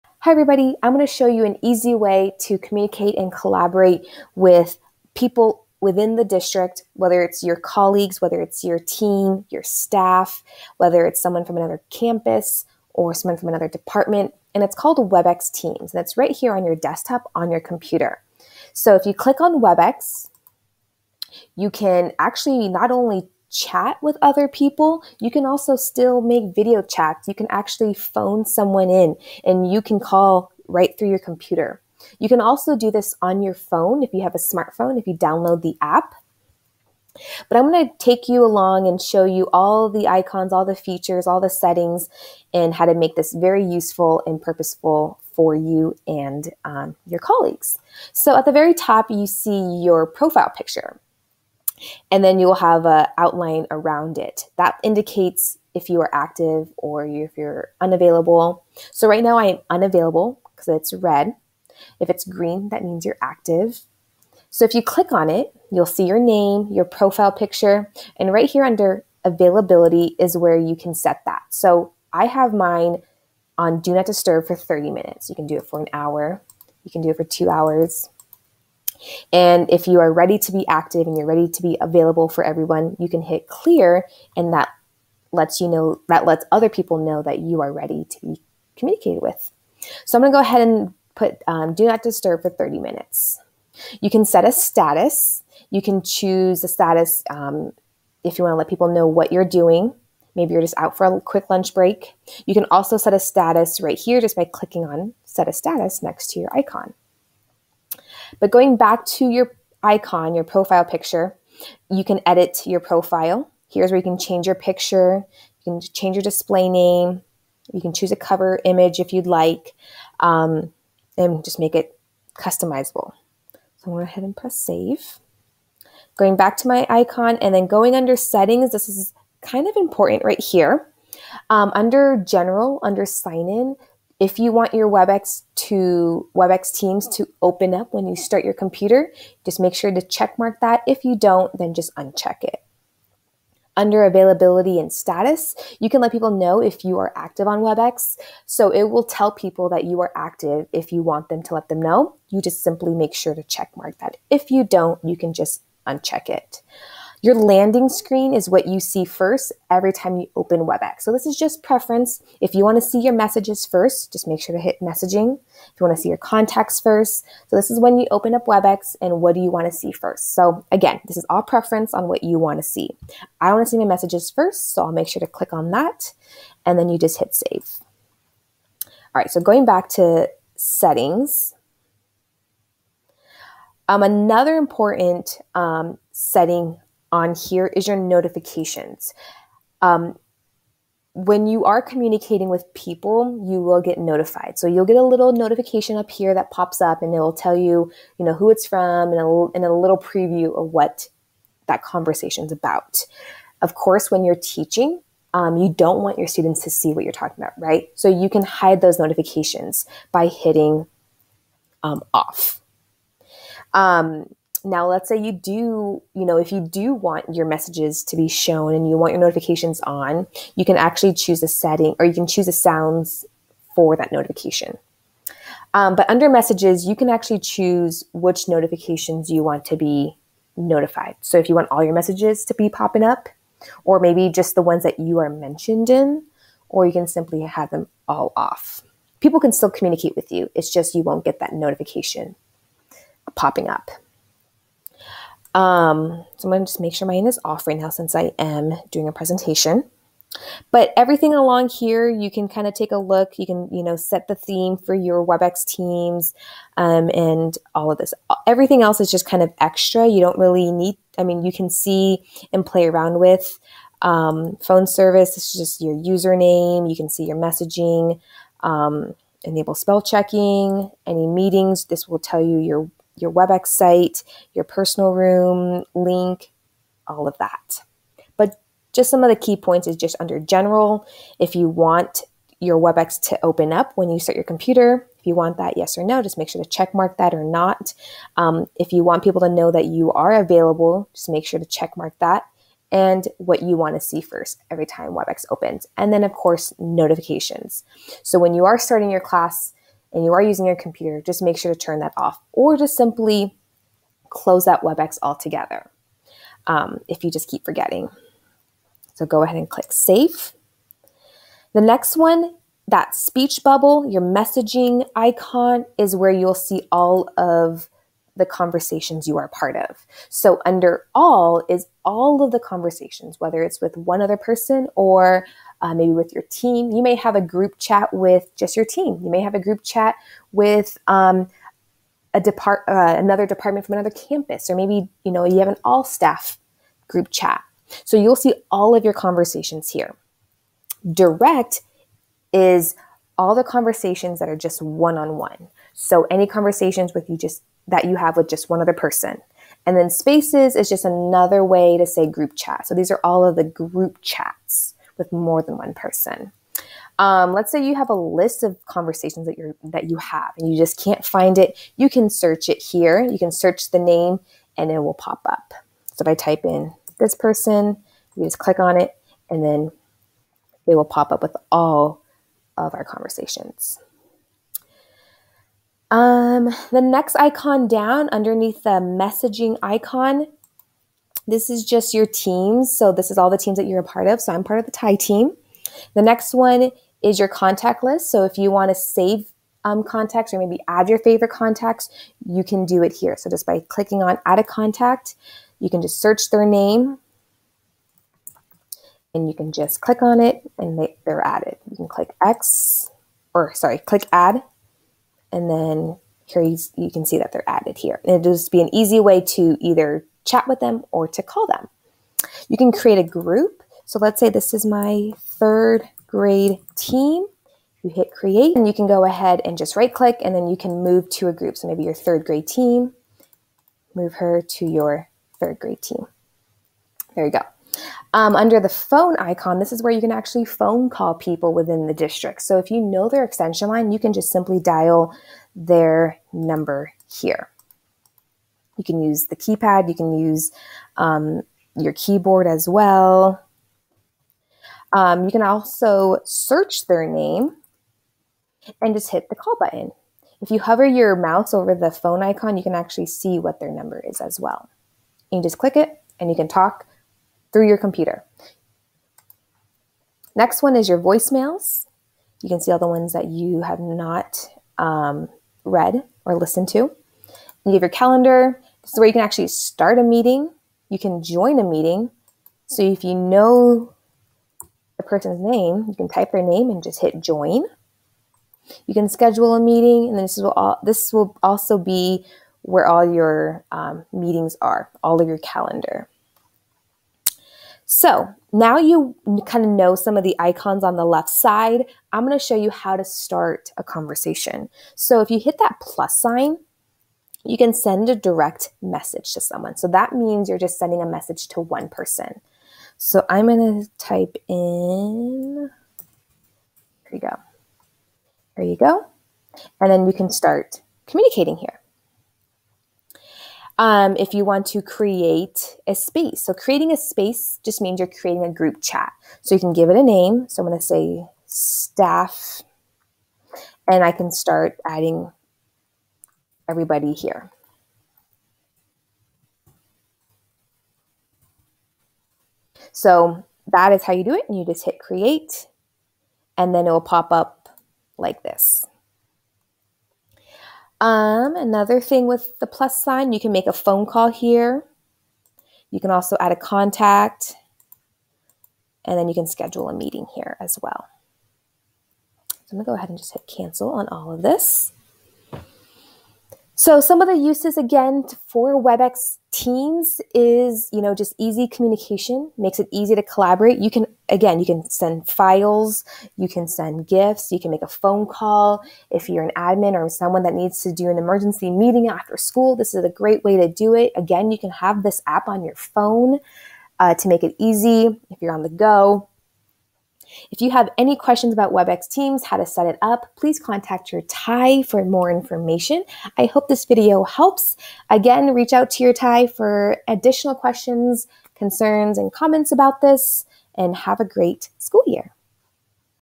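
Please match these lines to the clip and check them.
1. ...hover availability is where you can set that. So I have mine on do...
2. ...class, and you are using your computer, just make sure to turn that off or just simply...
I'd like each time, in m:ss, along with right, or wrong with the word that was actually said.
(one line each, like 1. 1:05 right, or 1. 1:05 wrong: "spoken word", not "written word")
1. 1:08 wrong: "under", not "hover"
2. 4:59 right.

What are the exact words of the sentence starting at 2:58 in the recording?
All right, so going back to settings, um, another important um, setting on here is your notifications.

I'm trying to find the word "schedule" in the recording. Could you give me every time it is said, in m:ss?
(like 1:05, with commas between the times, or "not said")
7:59, 9:09.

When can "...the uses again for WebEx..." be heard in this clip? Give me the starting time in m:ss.
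9:17.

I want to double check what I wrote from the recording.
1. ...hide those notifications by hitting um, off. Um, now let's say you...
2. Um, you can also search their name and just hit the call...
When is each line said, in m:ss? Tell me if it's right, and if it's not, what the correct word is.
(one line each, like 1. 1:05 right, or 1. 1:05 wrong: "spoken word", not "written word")
1. 3:28 right
2. 7:25 right.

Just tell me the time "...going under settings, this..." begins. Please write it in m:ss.
2:07.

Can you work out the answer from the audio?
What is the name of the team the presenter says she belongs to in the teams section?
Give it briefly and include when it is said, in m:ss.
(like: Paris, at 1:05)
TIE team, at 6:24.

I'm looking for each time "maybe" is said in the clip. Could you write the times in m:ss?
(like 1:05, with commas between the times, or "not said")
1:40, 3:53, 5:25, 5:34, 6:30, 7:01.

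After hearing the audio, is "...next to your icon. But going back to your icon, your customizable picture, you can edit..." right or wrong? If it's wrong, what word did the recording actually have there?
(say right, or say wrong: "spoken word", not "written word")
wrong: "profile", not "customizable".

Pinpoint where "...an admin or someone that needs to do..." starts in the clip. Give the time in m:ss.
9:29.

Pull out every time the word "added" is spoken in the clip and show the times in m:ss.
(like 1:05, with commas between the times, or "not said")
6:41, 6:47.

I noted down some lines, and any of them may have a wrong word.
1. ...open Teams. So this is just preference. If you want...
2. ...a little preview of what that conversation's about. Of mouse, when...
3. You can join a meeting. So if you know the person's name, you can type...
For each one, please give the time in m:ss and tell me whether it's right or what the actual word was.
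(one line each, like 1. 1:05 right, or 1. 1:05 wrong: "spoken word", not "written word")
1. 2:40 wrong: "WebEx", not "Teams"
2. 3:19 wrong: "course", not "mouse"
3. 7:51 right.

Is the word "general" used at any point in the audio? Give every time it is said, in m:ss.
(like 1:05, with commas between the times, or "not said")
2:12, 4:40.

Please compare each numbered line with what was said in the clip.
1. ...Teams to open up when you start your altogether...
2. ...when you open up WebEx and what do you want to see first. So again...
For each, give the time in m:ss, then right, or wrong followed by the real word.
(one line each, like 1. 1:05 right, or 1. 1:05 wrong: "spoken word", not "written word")
1. 2:16 wrong: "computer", not "altogether"
2. 2:47 right.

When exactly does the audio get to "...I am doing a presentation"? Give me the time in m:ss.
4:08.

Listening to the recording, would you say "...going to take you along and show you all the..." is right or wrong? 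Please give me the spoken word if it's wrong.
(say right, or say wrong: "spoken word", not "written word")
right.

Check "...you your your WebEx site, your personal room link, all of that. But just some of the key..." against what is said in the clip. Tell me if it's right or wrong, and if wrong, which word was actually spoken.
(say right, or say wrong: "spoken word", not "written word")
right.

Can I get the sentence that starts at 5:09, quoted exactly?
So go ahead and click save.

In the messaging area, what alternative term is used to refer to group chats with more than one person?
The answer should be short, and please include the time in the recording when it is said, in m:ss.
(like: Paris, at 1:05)
Spaces, at 5:50.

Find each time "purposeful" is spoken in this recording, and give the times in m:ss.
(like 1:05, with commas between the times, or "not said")
0:44.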